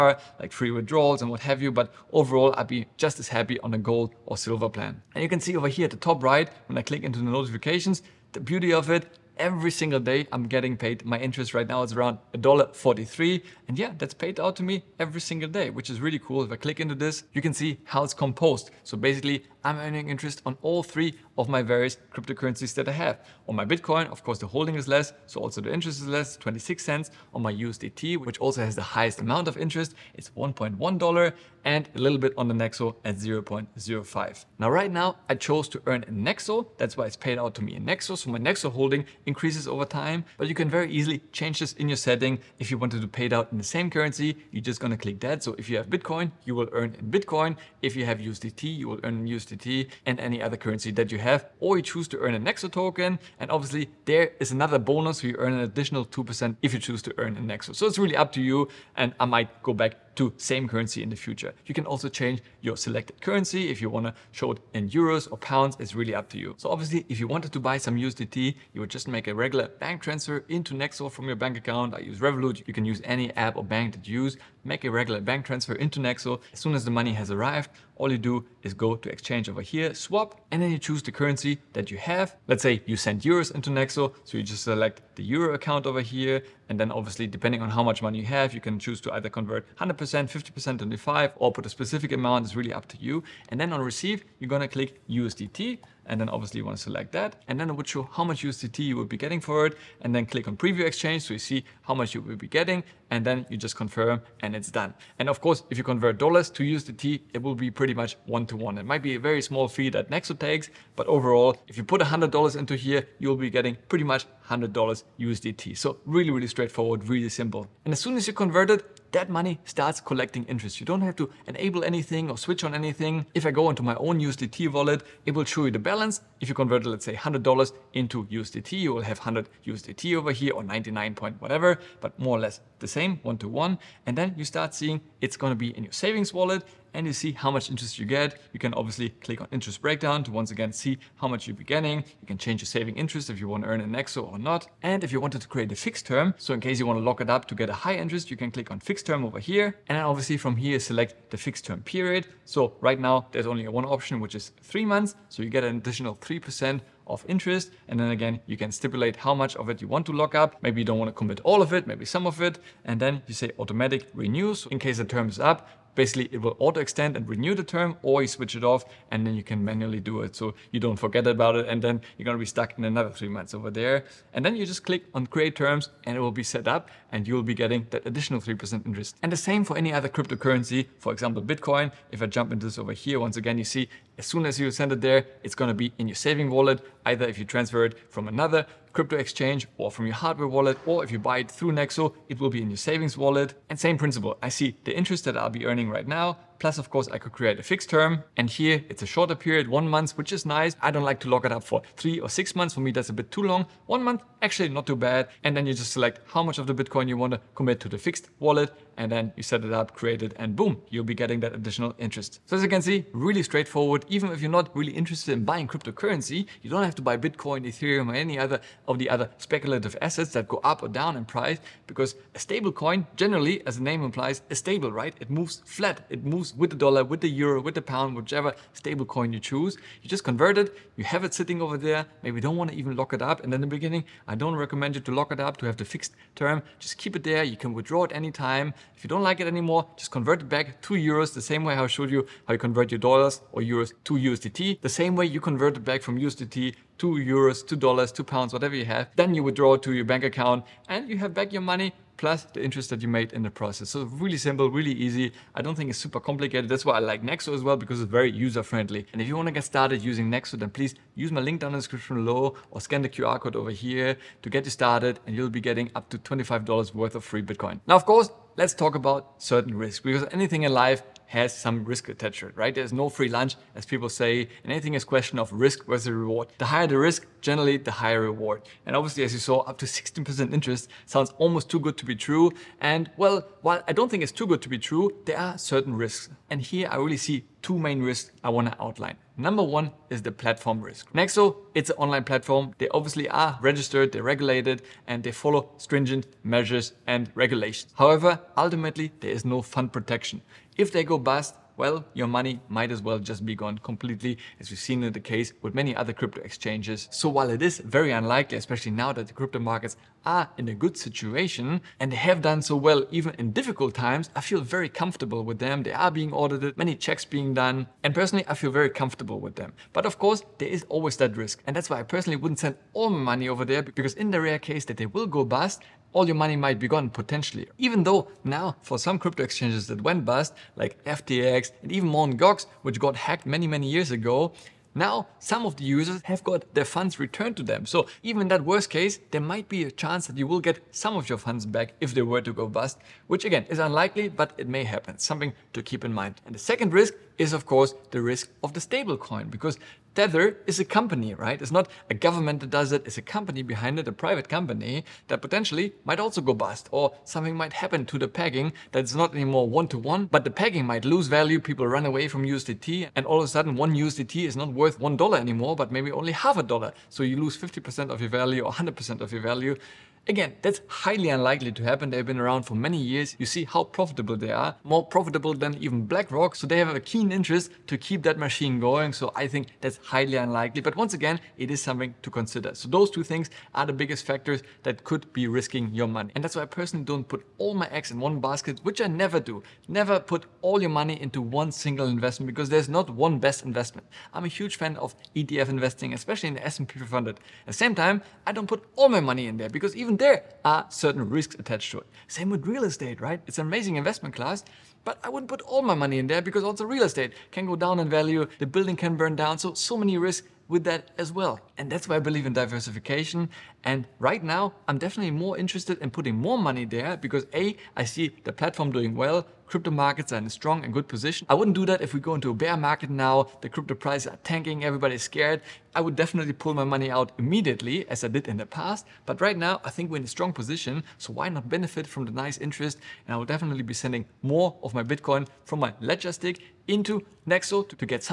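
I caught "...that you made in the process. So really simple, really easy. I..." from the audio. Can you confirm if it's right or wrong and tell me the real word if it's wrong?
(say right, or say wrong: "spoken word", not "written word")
right.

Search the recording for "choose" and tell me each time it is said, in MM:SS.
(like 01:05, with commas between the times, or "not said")
00:51, 00:56, 01:20, 01:28, 03:49.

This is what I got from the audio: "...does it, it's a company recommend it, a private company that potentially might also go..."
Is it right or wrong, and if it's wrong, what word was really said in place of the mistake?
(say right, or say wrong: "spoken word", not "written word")
wrong: "behind", not "recommend".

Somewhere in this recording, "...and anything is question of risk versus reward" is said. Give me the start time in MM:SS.
04:34.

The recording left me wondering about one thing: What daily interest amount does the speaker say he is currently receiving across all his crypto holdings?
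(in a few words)
$1.43.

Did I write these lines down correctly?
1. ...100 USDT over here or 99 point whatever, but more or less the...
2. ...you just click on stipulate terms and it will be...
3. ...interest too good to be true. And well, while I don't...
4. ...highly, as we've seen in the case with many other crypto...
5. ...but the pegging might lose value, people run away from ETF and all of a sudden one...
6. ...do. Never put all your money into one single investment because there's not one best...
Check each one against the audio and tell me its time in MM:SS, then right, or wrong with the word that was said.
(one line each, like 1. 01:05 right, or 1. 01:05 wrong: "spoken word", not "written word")
1. 02:09 right
2. 02:54 wrong: "create", not "stipulate"
3. 04:41 wrong: "almost", not "interest"
4. 05:03 wrong: "completely", not "highly"
5. 06:00 wrong: "USDT", not "ETF"
6. 06:29 right.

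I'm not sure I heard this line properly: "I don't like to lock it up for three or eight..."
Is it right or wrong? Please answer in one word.
wrong.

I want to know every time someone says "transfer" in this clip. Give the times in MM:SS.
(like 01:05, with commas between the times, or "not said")
01:10, 01:15, 03:07.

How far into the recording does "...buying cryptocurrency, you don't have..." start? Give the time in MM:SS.
03:35.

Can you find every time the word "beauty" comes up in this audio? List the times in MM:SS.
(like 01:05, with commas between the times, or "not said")
00:08.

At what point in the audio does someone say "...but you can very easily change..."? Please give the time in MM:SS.
00:40.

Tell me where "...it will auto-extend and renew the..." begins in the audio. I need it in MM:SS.
02:46.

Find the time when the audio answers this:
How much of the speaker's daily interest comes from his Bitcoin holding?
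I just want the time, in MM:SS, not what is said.
00:26.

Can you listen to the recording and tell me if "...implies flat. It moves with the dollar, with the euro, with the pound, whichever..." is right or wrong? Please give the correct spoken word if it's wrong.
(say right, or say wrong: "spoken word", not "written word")
wrong: "moves", not "implies".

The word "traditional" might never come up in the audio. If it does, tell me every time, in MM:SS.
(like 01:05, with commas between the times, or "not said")
not said.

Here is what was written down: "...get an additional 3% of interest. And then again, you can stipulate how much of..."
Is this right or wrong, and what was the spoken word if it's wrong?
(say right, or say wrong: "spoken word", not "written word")
right.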